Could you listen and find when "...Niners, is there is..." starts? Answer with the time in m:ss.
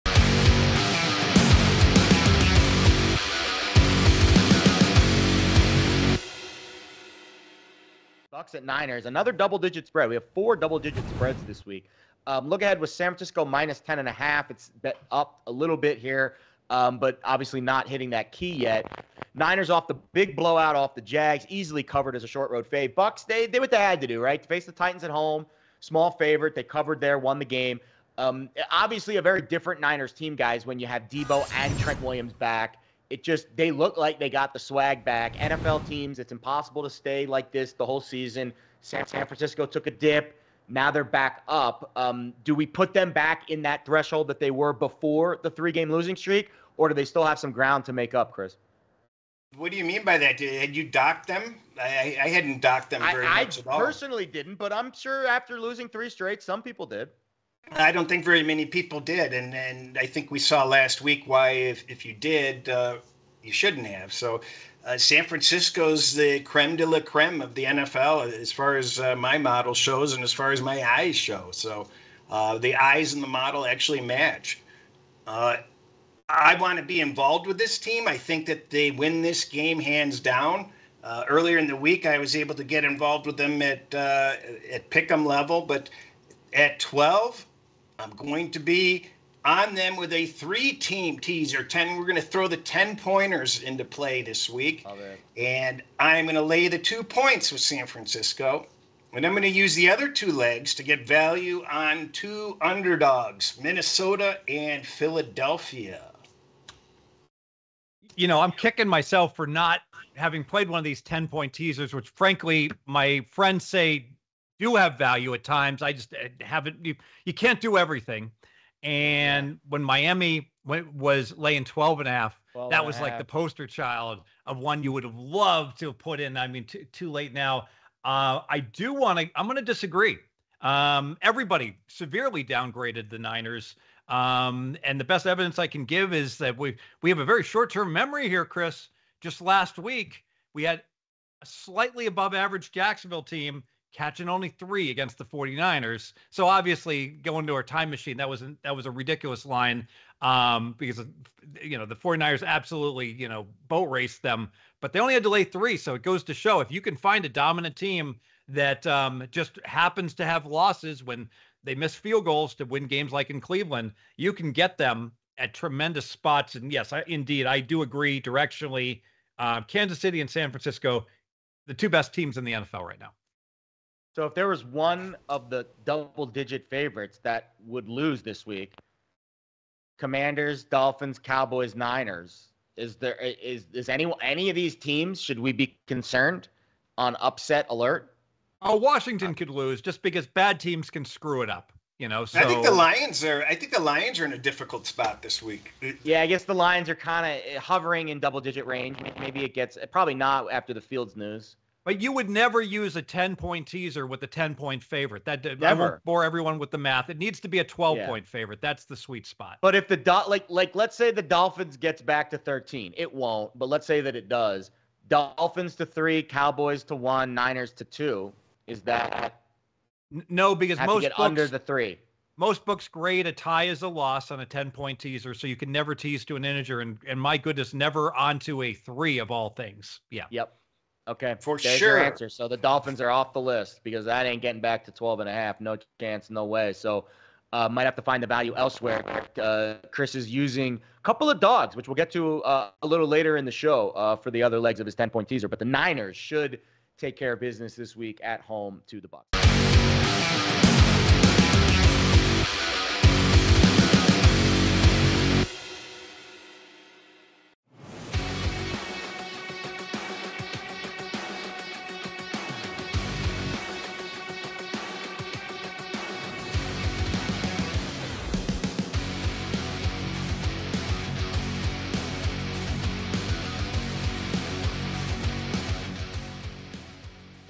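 3:01.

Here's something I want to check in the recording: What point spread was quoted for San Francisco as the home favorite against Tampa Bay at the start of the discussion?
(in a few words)
-10.5.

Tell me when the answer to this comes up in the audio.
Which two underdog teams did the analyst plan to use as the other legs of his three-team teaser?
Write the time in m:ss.
1:43.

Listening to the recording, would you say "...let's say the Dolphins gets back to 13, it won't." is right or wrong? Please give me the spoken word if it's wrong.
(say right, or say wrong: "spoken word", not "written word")
right.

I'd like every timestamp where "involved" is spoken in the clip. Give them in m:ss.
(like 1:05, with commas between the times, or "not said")
1:16, 1:22.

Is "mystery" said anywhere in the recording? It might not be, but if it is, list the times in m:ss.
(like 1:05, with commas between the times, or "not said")
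not said.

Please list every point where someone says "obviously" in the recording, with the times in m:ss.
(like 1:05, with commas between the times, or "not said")
0:17, 0:28, 2:26.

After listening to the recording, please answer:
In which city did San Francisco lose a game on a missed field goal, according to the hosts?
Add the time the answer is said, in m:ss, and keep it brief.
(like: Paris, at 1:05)
Cleveland, at 2:43.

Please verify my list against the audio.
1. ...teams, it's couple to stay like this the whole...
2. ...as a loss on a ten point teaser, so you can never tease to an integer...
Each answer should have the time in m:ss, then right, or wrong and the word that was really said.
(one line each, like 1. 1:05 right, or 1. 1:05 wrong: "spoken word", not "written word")
1. 0:35 wrong: "impossible", not "couple"
2. 3:43 right.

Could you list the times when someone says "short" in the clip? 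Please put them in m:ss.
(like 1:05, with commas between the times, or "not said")
0:22, 2:17.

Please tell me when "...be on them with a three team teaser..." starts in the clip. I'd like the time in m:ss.
1:28.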